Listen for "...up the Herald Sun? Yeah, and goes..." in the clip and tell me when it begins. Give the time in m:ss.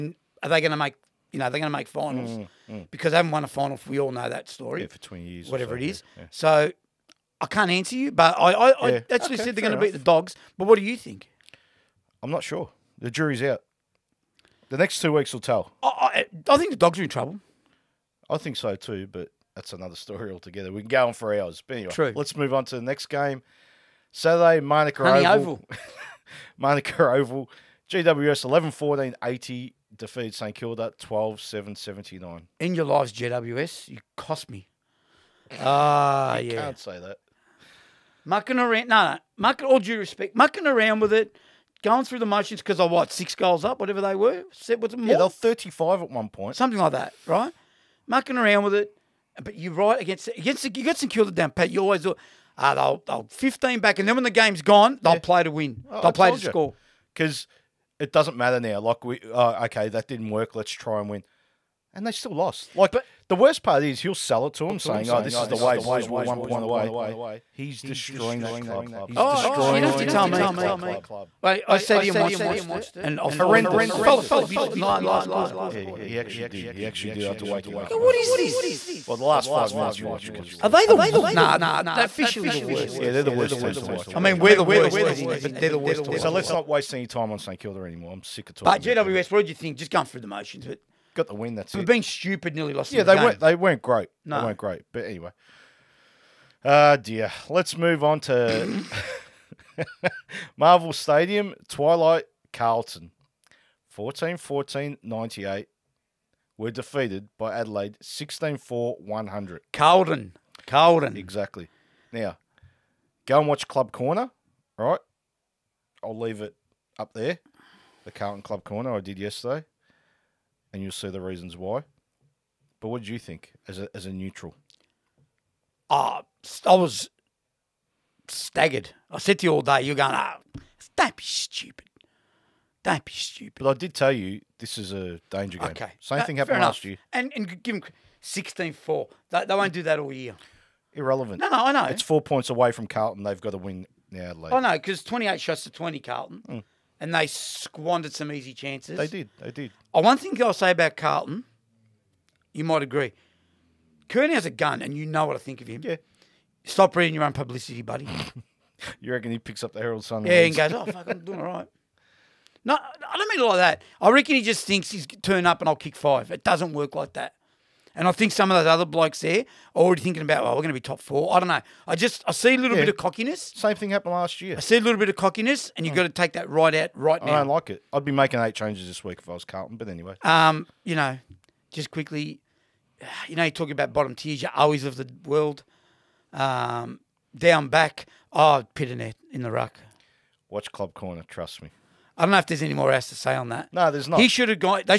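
2:39.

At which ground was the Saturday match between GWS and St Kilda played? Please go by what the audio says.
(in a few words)
Manuka Oval.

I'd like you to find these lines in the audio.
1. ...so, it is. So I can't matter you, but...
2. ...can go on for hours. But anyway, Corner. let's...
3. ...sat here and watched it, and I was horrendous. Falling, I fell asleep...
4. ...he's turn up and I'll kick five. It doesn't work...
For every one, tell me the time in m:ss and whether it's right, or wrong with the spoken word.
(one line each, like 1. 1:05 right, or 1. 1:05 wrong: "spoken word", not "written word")
1. 0:05 wrong: "answer", not "matter"
2. 0:20 wrong: "True", not "Corner"
3. 1:11 right
4. 2:44 right.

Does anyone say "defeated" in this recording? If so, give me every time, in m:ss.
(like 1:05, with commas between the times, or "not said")
0:29, 1:46.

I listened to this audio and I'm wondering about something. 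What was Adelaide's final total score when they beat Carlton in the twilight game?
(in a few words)
100.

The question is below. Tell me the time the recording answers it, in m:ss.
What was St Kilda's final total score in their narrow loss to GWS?
0:31.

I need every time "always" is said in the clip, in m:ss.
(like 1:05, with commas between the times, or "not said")
0:51, 3:04.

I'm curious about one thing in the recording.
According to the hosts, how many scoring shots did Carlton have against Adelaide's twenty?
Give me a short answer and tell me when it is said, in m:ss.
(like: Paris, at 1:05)
28, at 2:25.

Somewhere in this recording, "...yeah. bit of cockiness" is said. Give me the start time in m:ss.
2:52.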